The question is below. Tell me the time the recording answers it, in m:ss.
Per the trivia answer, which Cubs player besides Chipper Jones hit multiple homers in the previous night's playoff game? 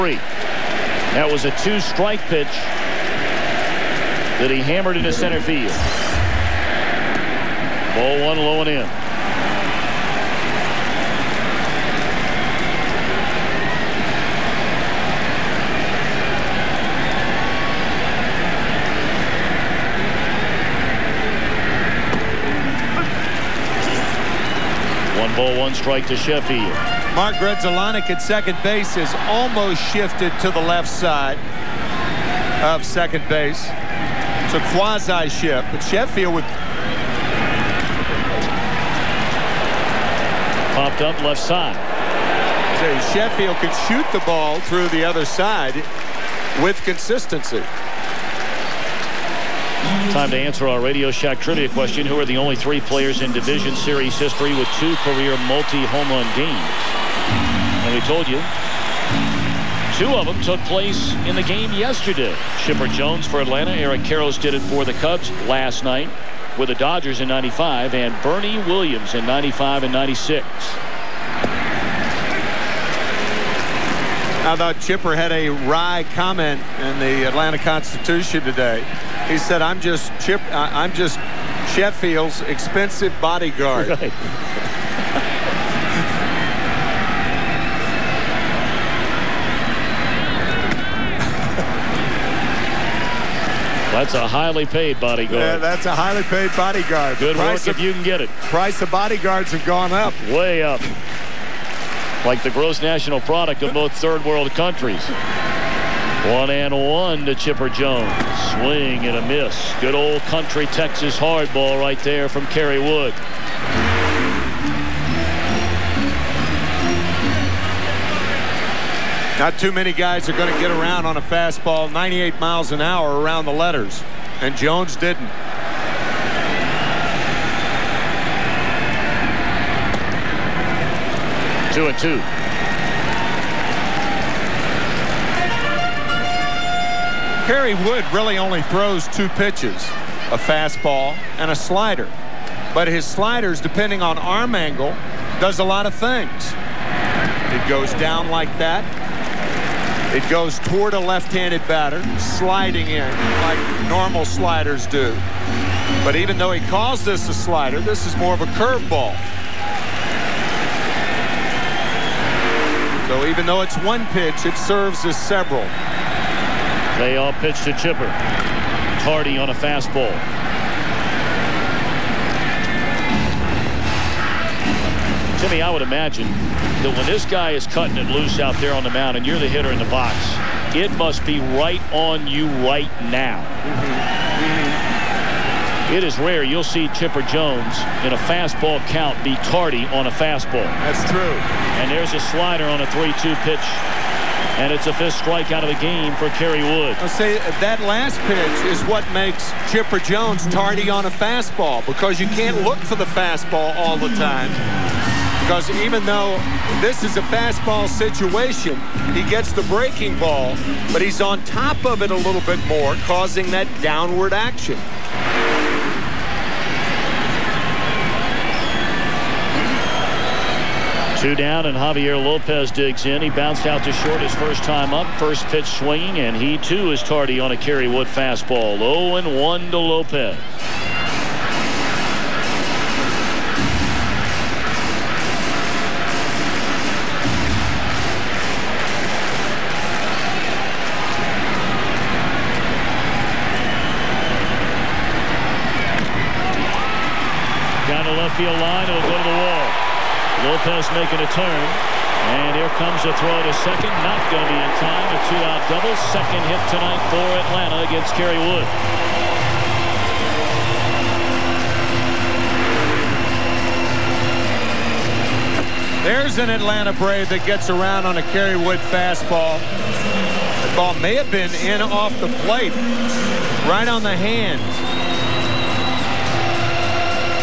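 1:03.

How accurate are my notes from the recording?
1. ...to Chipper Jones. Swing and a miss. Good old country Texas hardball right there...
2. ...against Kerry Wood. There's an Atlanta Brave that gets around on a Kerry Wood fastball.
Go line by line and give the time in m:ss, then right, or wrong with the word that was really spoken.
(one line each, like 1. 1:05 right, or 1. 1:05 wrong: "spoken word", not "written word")
1. 1:47 right
2. 4:17 right.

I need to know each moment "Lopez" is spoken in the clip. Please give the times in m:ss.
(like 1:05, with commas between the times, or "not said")
3:42, 3:49, 4:10.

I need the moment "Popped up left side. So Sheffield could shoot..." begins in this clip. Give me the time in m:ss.
0:40.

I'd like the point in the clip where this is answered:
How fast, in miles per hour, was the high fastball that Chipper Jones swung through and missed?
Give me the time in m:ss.
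2:01.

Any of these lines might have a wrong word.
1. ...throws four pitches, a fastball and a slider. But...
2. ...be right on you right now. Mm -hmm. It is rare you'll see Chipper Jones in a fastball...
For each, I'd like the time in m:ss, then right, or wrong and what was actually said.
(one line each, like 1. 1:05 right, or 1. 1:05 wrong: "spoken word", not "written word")
1. 2:18 wrong: "two", not "four"
2. 3:01 right.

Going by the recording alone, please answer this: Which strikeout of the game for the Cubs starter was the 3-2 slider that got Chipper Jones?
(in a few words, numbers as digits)
fifth.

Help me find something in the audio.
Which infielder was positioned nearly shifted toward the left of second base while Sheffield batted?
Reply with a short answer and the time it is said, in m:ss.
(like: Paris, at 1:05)
Mark Grudzielanek, at 0:27.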